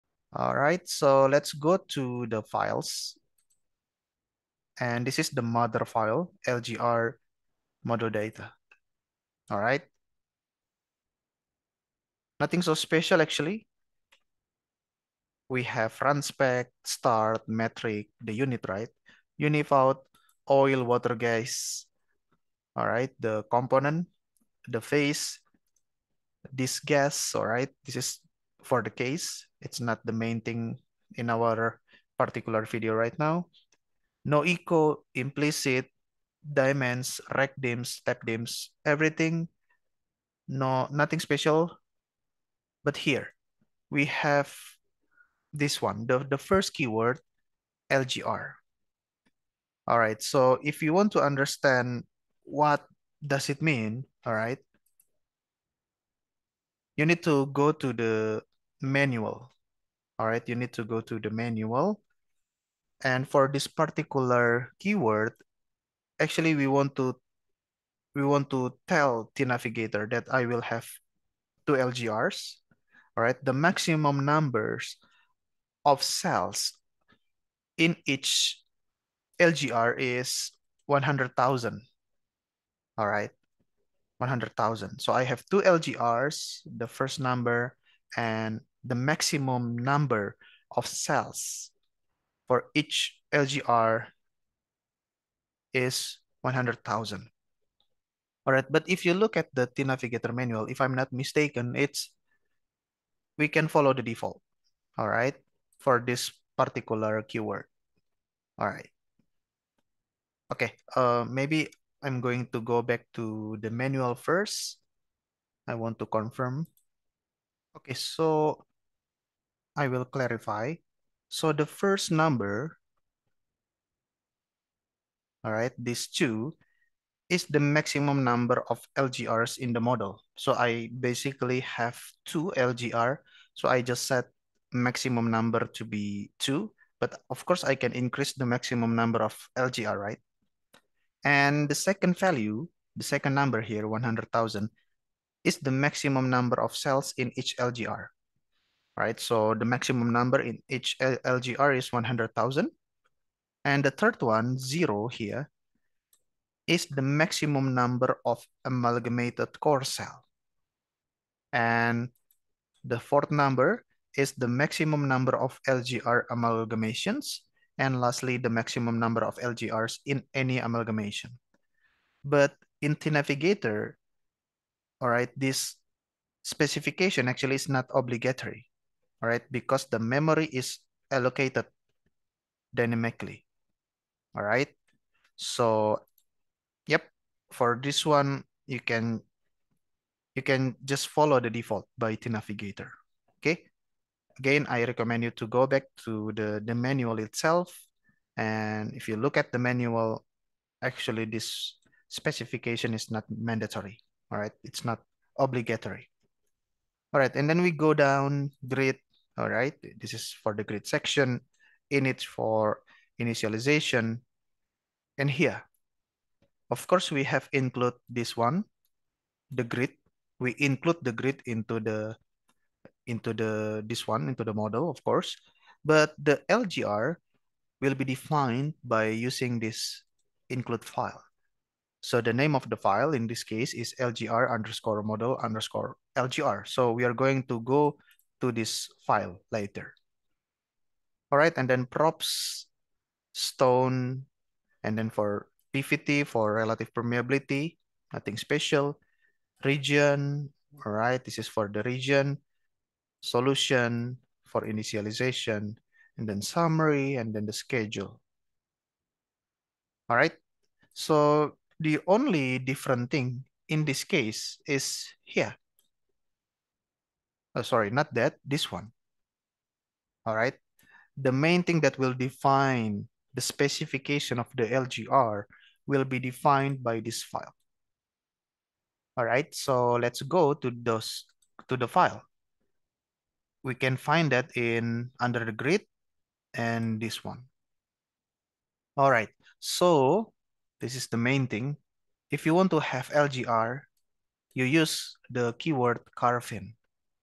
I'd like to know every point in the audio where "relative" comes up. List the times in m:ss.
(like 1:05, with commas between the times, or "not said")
4:06.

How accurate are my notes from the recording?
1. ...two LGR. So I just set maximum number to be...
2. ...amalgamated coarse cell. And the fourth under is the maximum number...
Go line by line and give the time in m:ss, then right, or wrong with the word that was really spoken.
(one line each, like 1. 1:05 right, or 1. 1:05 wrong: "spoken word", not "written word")
1. 2:12 right
2. 2:38 wrong: "number", not "under".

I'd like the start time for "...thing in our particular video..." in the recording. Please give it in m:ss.
0:30.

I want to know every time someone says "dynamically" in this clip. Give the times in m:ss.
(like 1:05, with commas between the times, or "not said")
3:02.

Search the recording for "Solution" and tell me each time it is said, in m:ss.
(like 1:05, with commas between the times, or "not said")
4:13.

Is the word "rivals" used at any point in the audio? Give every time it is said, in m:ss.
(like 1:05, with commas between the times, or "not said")
not said.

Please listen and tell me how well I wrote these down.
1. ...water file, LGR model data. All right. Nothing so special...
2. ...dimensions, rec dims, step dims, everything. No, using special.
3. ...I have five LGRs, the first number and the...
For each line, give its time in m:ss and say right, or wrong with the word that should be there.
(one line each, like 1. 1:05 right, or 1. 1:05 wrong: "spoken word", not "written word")
1. 0:05 wrong: "mother", not "water"
2. 0:36 wrong: "nothing", not "using"
3. 1:25 wrong: "two", not "five".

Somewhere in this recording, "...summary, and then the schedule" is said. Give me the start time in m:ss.
4:16.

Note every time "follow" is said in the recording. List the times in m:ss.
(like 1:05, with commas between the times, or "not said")
1:43, 3:11.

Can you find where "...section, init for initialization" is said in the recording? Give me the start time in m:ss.
3:30.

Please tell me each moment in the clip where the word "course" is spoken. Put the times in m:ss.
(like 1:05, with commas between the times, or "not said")
2:17, 3:36, 3:45.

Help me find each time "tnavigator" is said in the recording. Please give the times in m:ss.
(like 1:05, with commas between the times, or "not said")
1:09, 1:39, 2:52, 3:12.